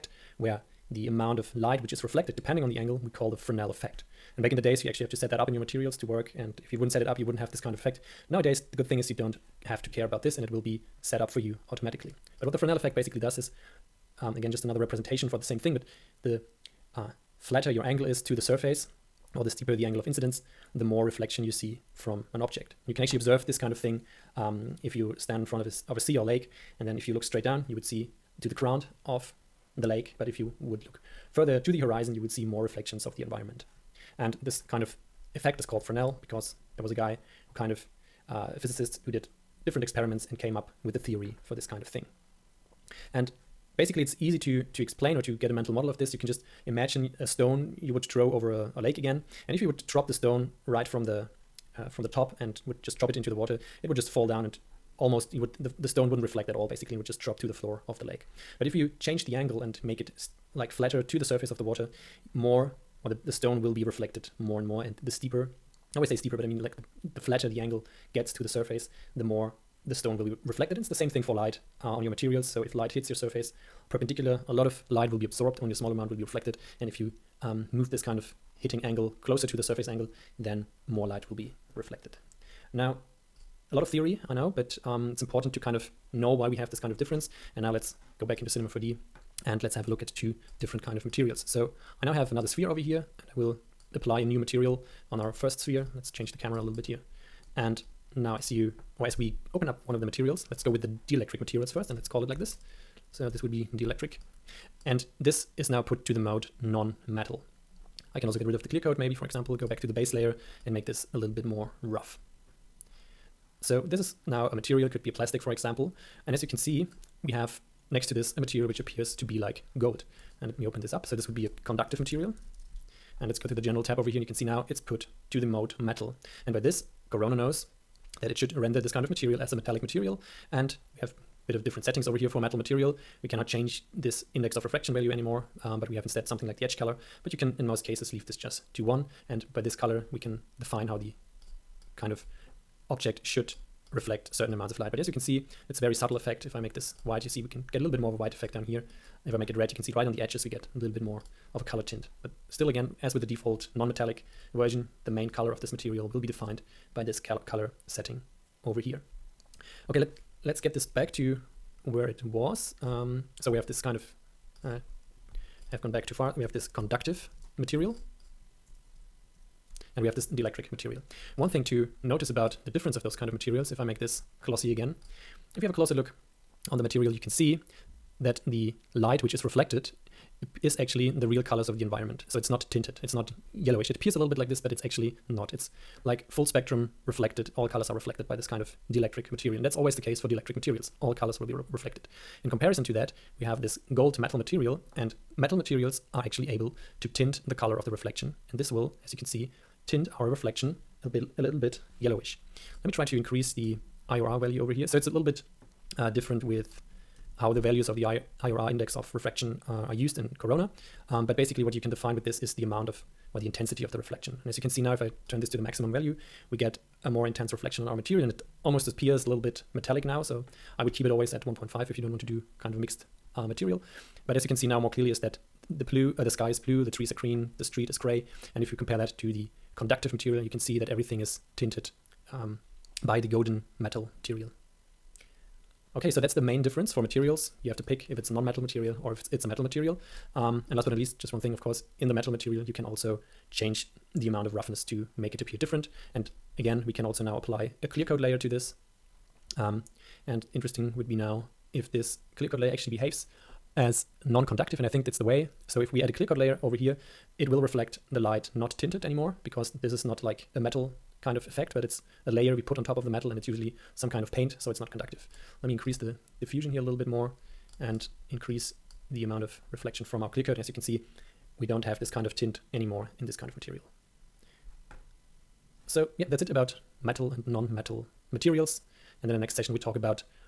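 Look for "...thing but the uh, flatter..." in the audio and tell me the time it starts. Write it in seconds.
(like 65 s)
15 s.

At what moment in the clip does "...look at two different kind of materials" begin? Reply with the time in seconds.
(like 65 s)
89 s.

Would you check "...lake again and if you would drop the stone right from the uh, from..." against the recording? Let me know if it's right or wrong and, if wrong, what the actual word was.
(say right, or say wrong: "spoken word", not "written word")
right.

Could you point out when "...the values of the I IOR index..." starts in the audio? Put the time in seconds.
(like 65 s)
207 s.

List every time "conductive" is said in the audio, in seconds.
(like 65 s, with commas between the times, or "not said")
121 s, 166 s, 229 s, 254 s, 264 s.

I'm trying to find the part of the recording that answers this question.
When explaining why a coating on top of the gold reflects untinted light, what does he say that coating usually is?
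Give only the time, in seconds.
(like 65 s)
264 s.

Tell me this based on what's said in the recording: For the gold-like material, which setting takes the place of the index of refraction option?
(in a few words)
Edge color.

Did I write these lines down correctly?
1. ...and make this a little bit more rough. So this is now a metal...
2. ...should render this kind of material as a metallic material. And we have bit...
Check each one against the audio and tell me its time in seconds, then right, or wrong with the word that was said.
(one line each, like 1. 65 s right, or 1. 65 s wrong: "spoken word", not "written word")
1. 110 s wrong: "material", not "metal"
2. 128 s right.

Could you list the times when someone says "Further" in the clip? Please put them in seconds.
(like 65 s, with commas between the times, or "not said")
31 s.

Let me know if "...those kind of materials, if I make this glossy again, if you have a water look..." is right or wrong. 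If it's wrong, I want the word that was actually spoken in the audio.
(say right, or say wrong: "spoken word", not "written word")
wrong: "closer", not "water".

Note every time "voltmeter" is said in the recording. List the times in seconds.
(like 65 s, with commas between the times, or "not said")
not said.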